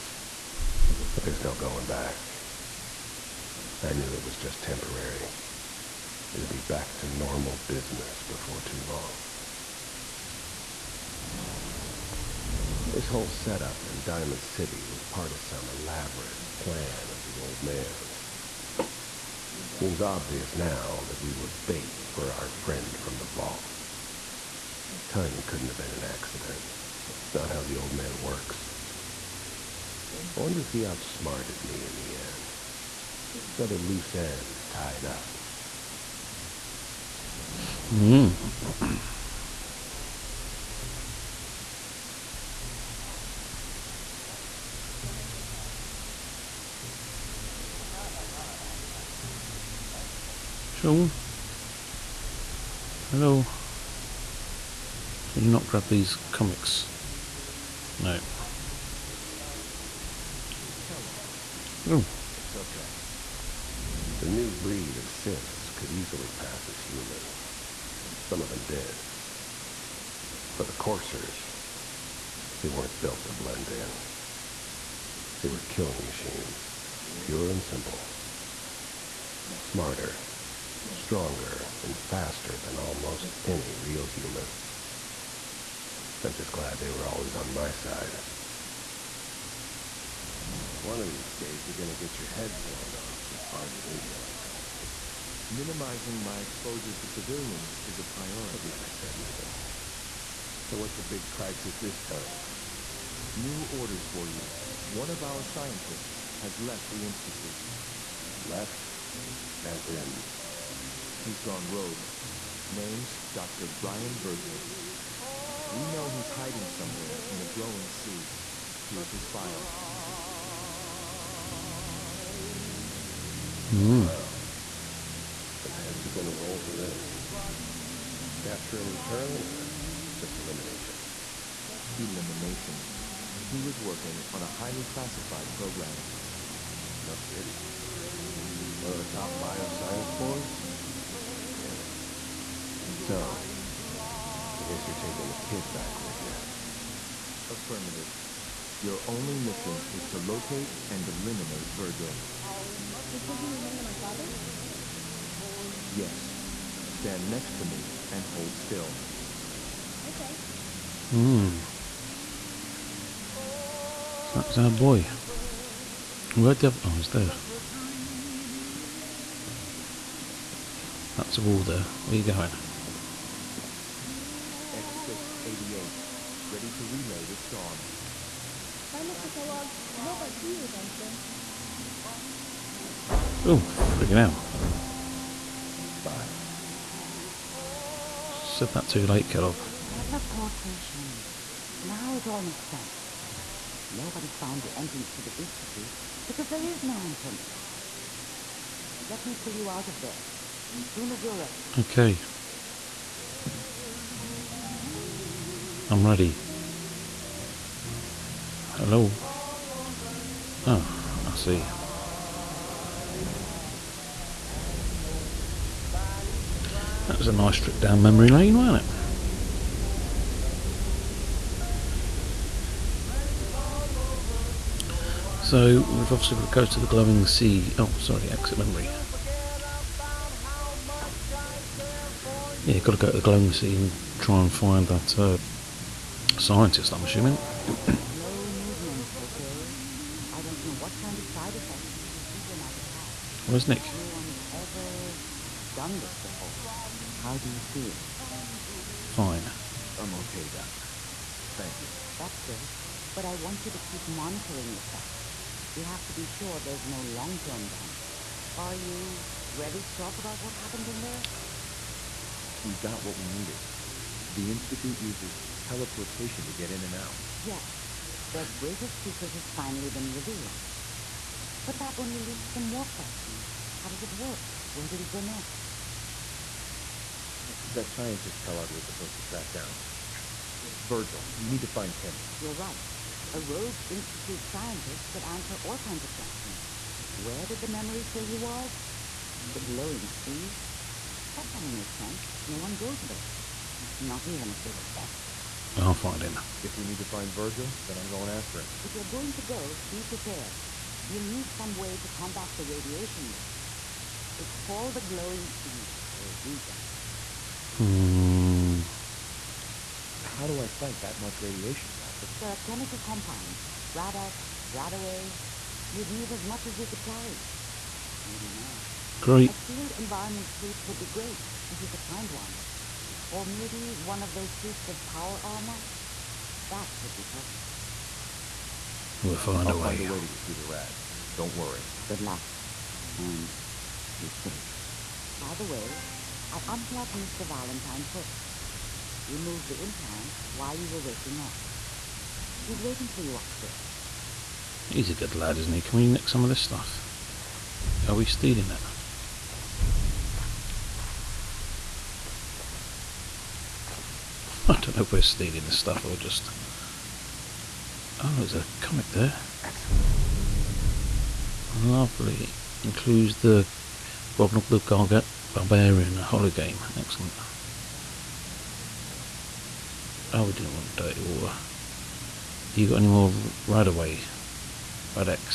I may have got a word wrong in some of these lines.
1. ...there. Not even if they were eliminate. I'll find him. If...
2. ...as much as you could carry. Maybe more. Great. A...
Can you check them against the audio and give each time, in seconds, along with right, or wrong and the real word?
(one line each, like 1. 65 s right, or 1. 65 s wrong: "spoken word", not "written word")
1. 293 s wrong: "desperate", not "eliminate"
2. 316 s right.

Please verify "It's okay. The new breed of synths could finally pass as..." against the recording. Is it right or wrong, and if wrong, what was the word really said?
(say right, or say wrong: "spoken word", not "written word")
wrong: "easily", not "finally".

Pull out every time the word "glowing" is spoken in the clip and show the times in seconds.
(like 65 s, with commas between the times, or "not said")
117 s, 226 s, 233 s, 289 s, 305 s.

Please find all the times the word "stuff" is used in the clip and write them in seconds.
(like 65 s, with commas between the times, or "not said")
346 s, 355 s.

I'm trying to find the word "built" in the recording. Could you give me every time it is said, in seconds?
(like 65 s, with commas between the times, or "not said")
73 s.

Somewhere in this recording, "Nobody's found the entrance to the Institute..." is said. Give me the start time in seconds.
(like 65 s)
193 s.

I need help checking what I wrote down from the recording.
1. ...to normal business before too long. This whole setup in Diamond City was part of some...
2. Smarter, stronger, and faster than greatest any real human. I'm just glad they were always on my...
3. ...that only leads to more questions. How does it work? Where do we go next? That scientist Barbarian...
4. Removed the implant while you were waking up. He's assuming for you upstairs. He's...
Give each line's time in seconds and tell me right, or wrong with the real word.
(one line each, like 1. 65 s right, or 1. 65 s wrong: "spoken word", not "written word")
1. 6 s right
2. 79 s wrong: "almost", not "greatest"
3. 271 s wrong: "Kellogg", not "Barbarian"
4. 339 s wrong: "waiting", not "assuming".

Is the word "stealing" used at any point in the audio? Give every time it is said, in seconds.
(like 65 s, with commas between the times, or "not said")
348 s, 355 s.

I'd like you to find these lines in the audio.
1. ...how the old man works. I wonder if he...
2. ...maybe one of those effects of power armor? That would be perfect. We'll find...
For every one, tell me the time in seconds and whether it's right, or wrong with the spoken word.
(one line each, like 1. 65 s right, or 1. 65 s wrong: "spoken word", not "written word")
1. 27 s right
2. 323 s wrong: "suits", not "effects".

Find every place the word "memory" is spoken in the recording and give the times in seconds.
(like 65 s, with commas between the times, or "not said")
218 s, 228 s, 287 s.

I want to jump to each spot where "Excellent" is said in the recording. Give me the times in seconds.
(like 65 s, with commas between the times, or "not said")
359 s, 367 s.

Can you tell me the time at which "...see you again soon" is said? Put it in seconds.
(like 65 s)
180 s.